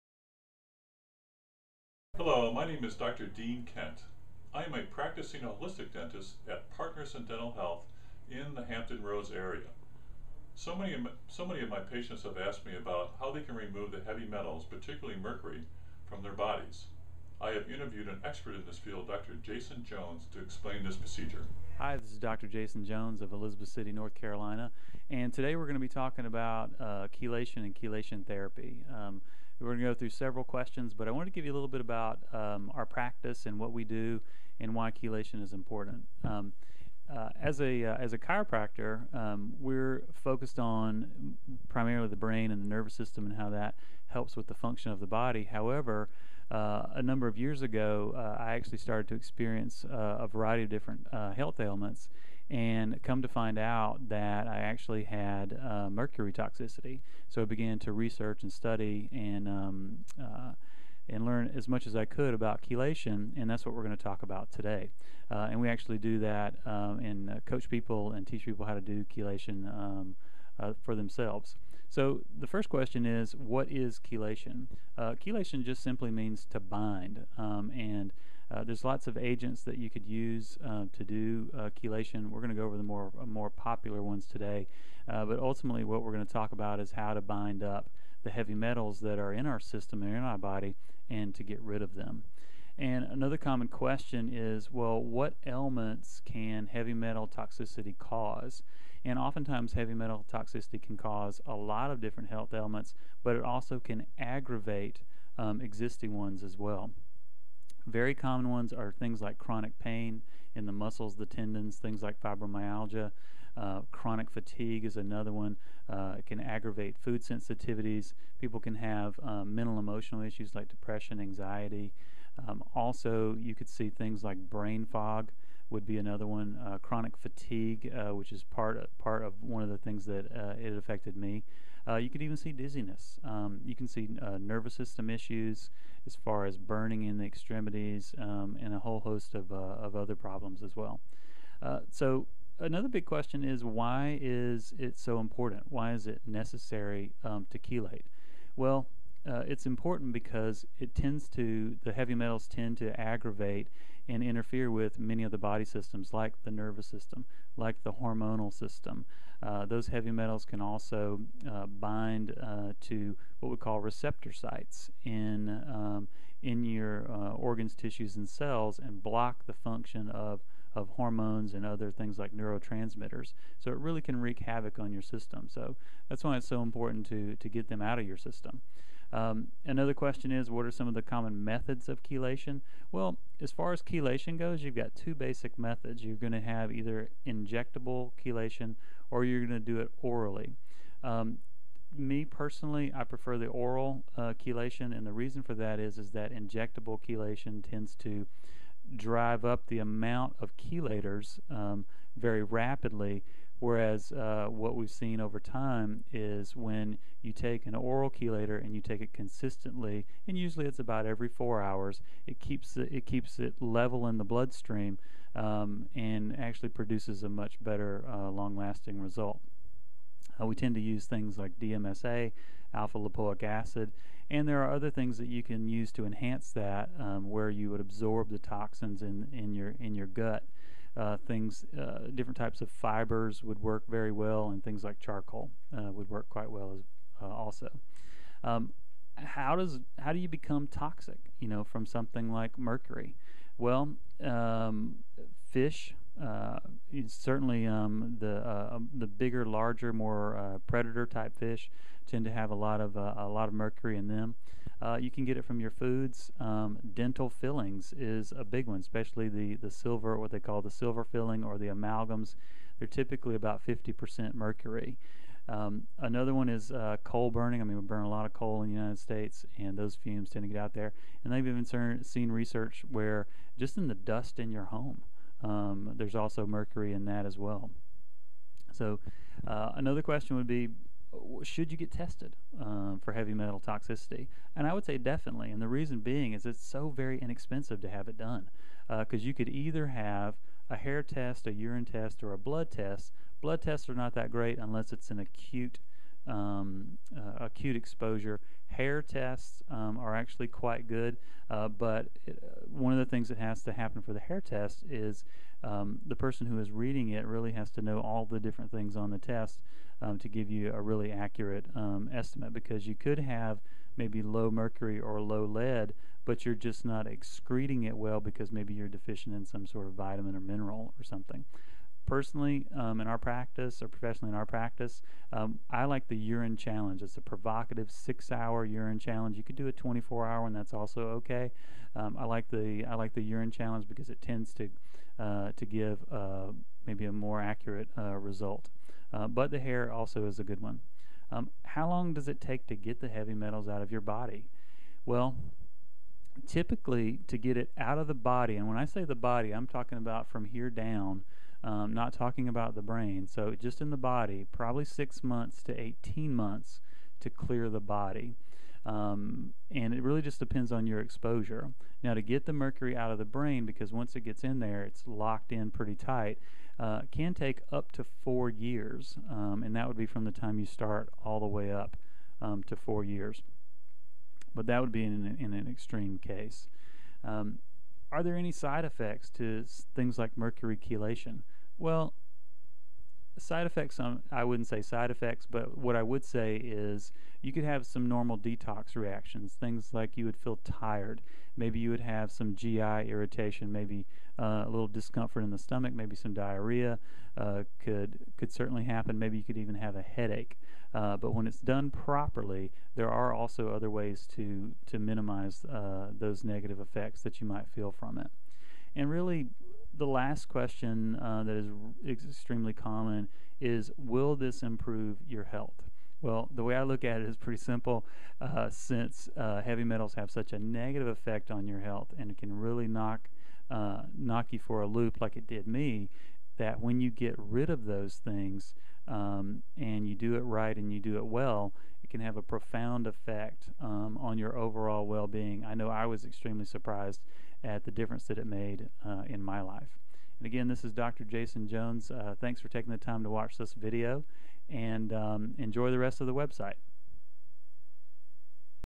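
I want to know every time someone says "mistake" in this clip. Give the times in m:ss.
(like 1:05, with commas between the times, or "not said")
not said.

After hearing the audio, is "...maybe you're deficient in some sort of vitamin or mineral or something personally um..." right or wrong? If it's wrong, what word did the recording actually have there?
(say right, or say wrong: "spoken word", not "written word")
right.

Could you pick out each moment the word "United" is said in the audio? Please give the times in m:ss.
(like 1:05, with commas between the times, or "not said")
4:28.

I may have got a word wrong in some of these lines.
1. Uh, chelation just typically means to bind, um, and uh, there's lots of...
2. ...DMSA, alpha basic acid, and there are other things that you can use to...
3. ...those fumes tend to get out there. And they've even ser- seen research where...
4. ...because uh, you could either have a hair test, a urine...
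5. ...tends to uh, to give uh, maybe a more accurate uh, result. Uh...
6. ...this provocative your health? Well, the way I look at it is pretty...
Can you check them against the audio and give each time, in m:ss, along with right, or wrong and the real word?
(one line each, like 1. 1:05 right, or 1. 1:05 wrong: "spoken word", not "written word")
1. 1:14 wrong: "simply", not "typically"
2. 3:41 wrong: "lipoic", not "basic"
3. 4:29 right
4. 4:48 right
5. 5:34 right
6. 6:54 wrong: "improve", not "provocative".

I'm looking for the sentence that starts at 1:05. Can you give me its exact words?
Uh, and we actually do that um, and uh, coach people and teach people how to do chelation um, uh, for themselves.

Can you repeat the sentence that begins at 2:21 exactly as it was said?
so another big question is why is it so important?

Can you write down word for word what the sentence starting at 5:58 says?
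Um, and it really just depends on your exposure.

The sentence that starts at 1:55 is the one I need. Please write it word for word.
Uh, it can aggravate food sensitivities.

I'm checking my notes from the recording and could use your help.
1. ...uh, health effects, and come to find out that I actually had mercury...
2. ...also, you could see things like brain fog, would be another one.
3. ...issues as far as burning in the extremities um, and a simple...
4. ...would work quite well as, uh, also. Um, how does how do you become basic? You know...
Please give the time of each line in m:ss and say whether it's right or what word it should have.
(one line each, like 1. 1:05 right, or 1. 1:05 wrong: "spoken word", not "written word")
1. 0:51 wrong: "ailments", not "effects"
2. 2:02 right
3. 2:15 wrong: "whole", not "simple"
4. 3:55 wrong: "toxic", not "basic".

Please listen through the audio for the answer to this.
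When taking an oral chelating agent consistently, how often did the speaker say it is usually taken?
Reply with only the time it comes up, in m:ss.
3:31.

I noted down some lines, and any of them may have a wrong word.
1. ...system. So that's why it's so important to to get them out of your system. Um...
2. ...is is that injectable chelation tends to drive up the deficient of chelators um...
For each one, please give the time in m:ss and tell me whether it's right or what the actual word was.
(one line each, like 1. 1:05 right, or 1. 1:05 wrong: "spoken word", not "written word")
1. 2:55 right
2. 3:15 wrong: "amount", not "deficient".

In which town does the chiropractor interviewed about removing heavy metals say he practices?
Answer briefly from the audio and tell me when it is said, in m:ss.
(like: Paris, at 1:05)
Elizabeth City, at 0:23.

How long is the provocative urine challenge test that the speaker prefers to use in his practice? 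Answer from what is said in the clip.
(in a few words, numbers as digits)
6 hours.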